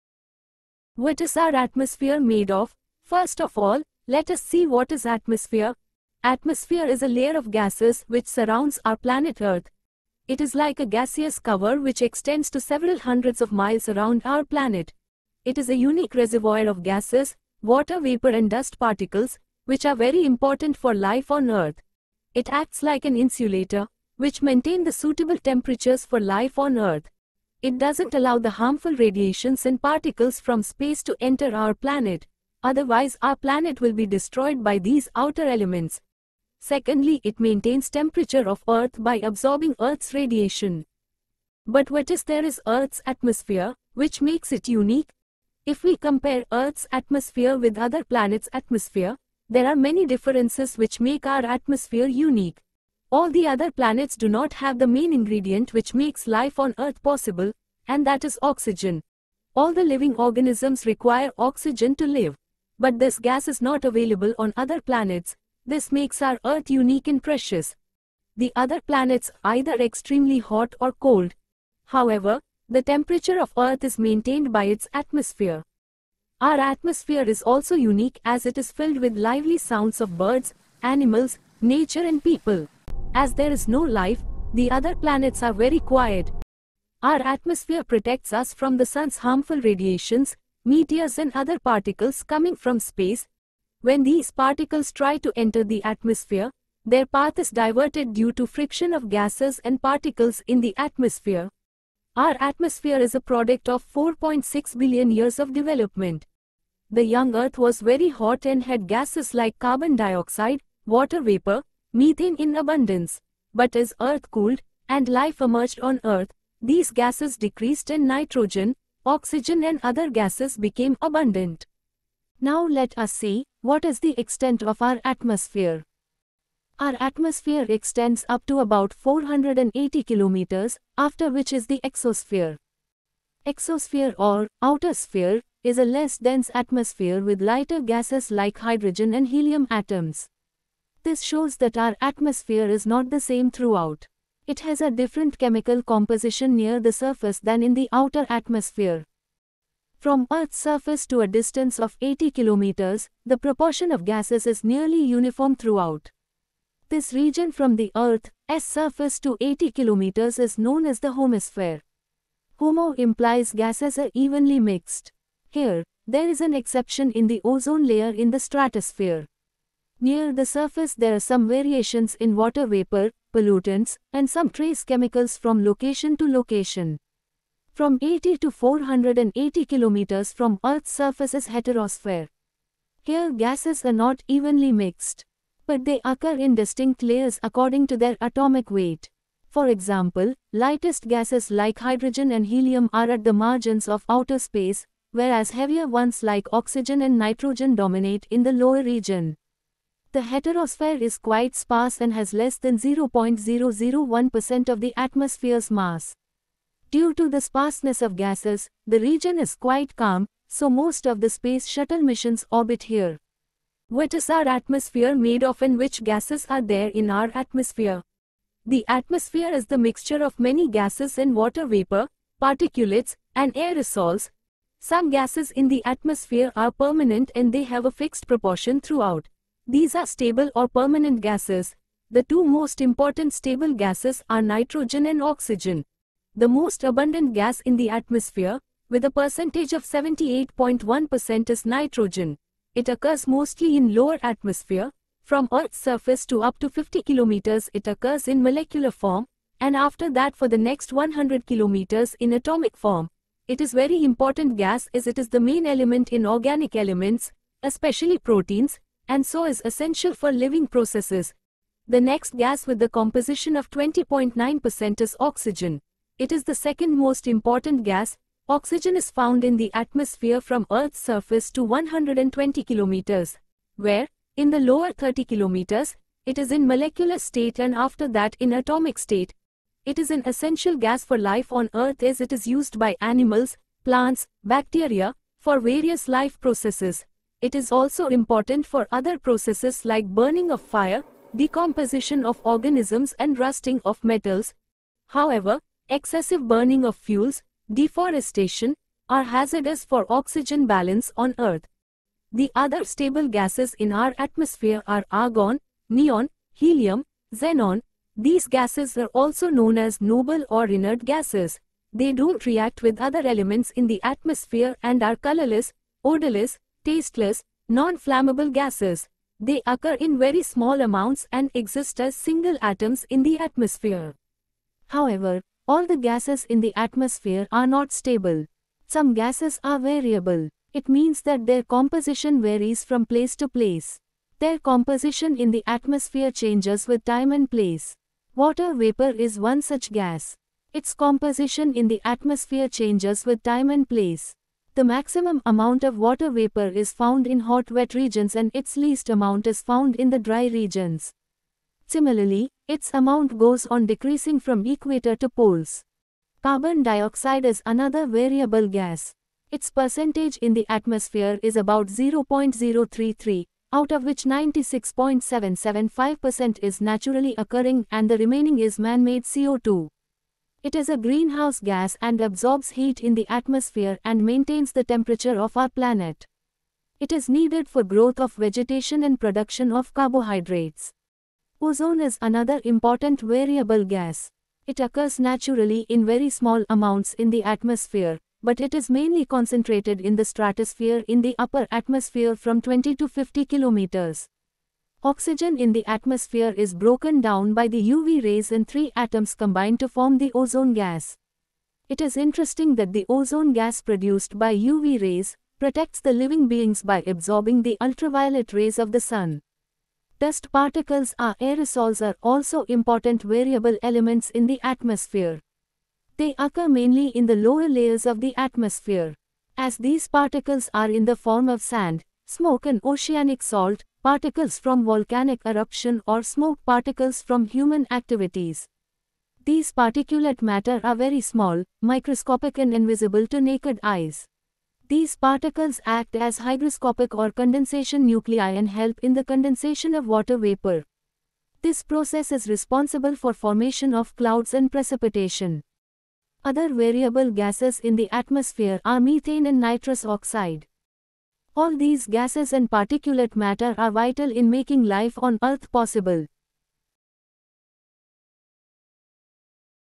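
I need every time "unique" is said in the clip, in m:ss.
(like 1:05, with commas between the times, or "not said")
0:15, 0:44, 0:52, 1:06, 1:17.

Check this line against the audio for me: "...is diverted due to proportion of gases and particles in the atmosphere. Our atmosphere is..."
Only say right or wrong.
wrong.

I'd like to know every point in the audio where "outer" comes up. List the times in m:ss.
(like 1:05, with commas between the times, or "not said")
0:35, 2:14, 2:27, 3:14.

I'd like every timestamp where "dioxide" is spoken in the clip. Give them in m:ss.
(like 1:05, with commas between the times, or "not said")
1:49, 5:56.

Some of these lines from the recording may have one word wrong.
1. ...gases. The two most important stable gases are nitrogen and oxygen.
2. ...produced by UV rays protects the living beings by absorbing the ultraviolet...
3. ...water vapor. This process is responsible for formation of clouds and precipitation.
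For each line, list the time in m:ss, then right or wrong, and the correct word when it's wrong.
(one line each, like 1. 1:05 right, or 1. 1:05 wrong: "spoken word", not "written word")
1. 3:51 right
2. 6:43 right
3. 7:20 right.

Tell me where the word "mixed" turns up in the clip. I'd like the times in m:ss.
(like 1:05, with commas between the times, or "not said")
2:44, 3:04.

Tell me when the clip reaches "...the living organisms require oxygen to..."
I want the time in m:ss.
0:59.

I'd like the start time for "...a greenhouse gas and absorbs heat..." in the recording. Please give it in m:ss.
6:10.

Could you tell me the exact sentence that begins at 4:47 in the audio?
It is also important for other processes like burning of fire, decomposition of organisms and rusting of metals.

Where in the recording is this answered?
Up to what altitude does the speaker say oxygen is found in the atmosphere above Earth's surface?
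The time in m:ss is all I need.
4:31.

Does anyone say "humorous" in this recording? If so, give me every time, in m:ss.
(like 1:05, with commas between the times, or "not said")
not said.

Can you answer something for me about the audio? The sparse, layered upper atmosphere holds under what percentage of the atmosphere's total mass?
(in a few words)
0.001%.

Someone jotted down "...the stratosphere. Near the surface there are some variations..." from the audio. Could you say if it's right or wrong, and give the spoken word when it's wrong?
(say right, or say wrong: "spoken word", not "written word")
right.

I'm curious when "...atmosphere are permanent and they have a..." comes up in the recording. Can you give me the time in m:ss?
3:45.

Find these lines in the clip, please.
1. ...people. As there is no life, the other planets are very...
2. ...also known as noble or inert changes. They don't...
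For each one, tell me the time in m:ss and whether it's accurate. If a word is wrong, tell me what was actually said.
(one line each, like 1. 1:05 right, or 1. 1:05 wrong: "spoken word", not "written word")
1. 1:22 right
2. 5:09 wrong: "gases", not "changes".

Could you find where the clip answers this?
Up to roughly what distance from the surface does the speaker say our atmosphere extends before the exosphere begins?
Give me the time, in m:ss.
2:08.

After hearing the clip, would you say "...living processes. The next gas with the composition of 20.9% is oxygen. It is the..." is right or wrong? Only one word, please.
right.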